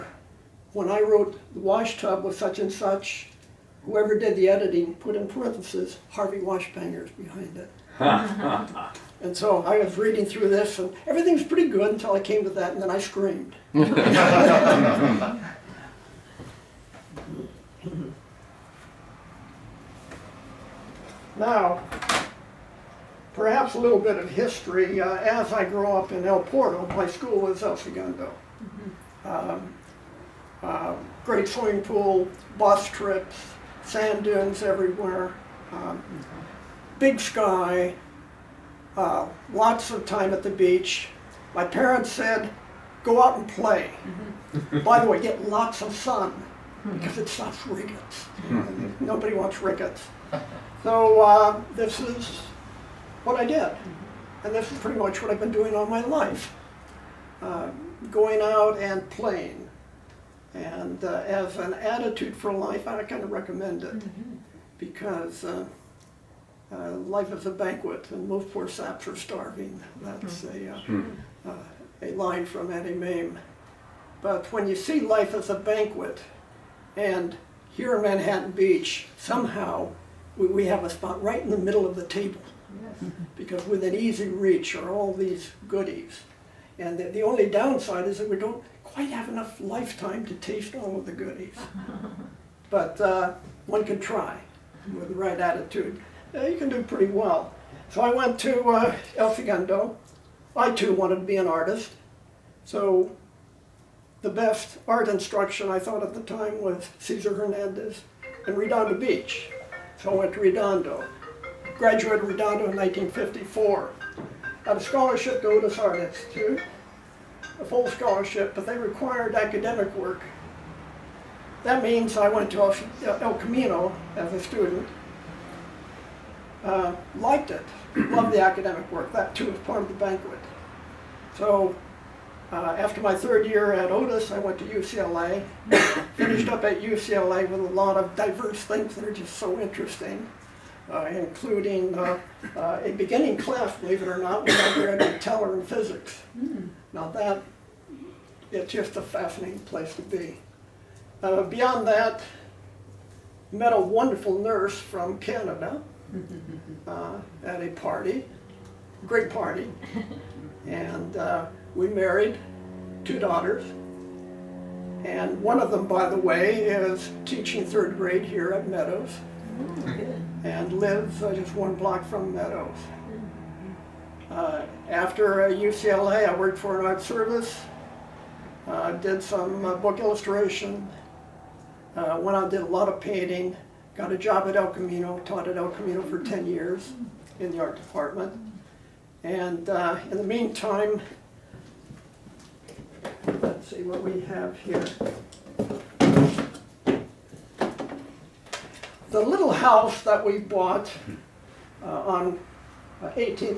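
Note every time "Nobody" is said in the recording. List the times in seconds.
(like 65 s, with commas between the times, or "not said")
49 s.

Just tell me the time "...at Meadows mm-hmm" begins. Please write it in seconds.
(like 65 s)
168 s.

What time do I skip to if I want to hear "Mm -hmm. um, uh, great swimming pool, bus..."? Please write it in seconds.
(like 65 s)
28 s.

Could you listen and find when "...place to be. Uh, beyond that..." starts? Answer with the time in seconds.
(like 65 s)
149 s.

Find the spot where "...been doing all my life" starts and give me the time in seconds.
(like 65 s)
55 s.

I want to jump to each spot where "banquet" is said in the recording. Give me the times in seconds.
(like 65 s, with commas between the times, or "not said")
67 s, 75 s, 129 s.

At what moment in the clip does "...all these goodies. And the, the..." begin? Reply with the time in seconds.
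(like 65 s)
84 s.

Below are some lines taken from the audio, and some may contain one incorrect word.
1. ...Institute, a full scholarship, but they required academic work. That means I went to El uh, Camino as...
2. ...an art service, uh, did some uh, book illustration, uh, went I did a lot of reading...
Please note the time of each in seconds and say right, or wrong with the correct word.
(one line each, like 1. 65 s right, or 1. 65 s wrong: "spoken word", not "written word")
1. 115 s right
2. 176 s wrong: "painting", not "reading".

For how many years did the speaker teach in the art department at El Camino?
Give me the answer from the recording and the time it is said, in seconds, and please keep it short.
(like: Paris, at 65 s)
10, at 186 s.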